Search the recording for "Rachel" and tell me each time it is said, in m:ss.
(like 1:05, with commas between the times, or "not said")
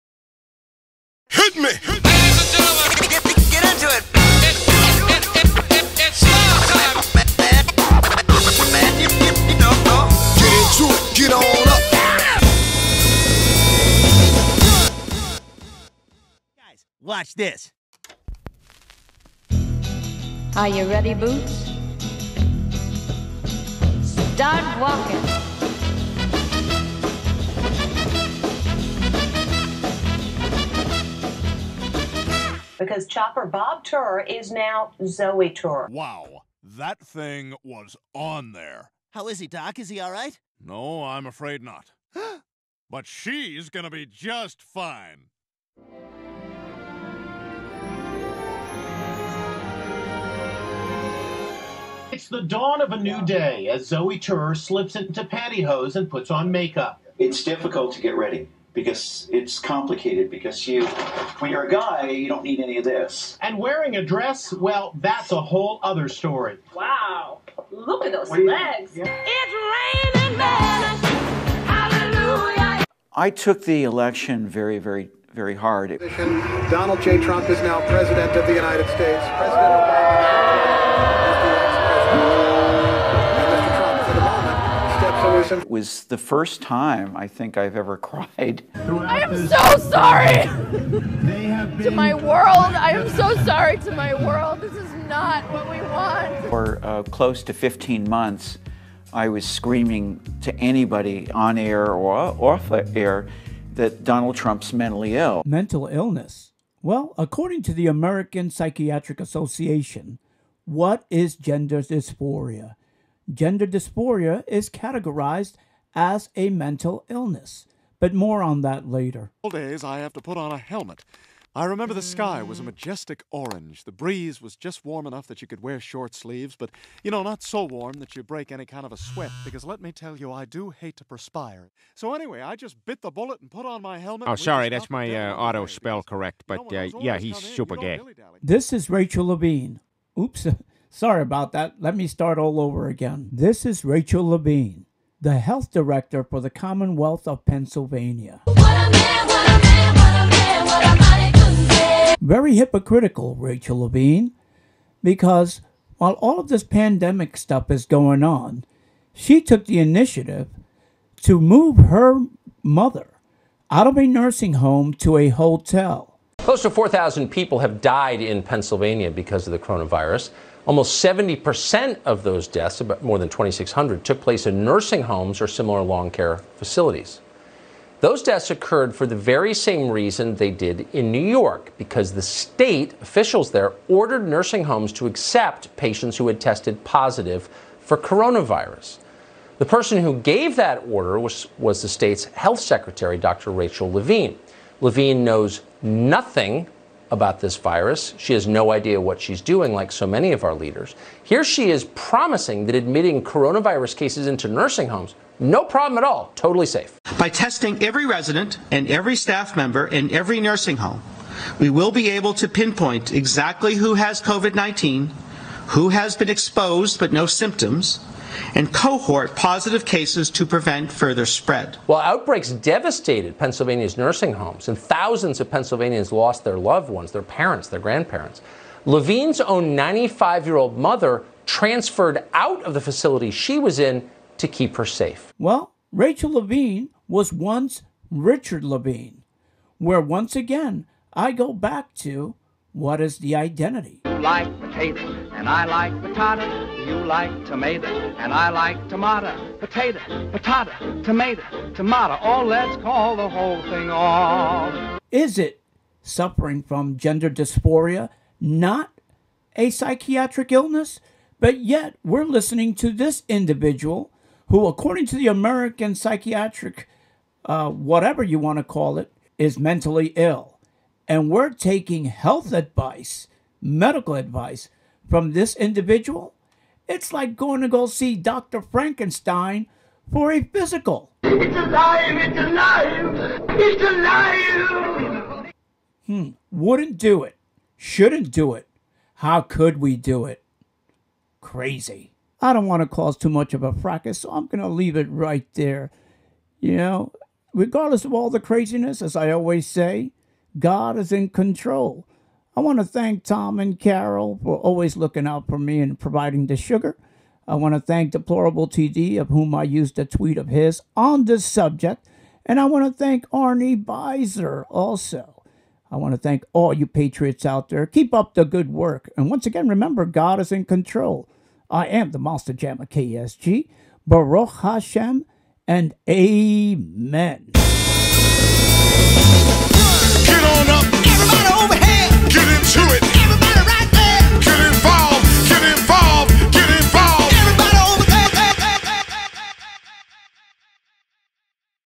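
2:18, 2:23, 2:33, 3:13, 3:55.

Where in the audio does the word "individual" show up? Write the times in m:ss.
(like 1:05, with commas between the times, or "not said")
4:23, 4:35.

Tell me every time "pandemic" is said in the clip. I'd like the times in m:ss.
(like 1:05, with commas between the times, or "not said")
2:36.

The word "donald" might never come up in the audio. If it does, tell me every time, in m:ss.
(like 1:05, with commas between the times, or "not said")
1:16, 1:44.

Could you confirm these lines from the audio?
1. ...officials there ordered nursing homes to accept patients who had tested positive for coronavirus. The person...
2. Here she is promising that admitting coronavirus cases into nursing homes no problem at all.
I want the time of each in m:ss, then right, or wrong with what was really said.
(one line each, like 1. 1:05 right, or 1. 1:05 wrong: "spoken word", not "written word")
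1. 3:03 right
2. 3:21 right.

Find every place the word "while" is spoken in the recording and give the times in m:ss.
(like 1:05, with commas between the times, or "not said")
2:35, 3:41.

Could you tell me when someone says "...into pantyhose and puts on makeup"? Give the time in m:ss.
0:54.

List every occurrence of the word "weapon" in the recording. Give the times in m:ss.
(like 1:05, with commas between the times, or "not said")
not said.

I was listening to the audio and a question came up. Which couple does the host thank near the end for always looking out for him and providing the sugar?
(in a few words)
Tom and Carol.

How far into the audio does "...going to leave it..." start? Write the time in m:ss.
4:54.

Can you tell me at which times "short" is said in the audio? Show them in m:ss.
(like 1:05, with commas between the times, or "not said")
2:05.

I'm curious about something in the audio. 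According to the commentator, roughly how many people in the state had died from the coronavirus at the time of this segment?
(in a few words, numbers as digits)
4,000.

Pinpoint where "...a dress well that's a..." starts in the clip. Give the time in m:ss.
1:03.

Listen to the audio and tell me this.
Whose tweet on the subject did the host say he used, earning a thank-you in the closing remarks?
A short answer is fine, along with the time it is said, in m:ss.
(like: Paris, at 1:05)
Deplorable TD, at 5:08.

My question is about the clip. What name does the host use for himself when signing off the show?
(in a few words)
Monster Jammer KSG.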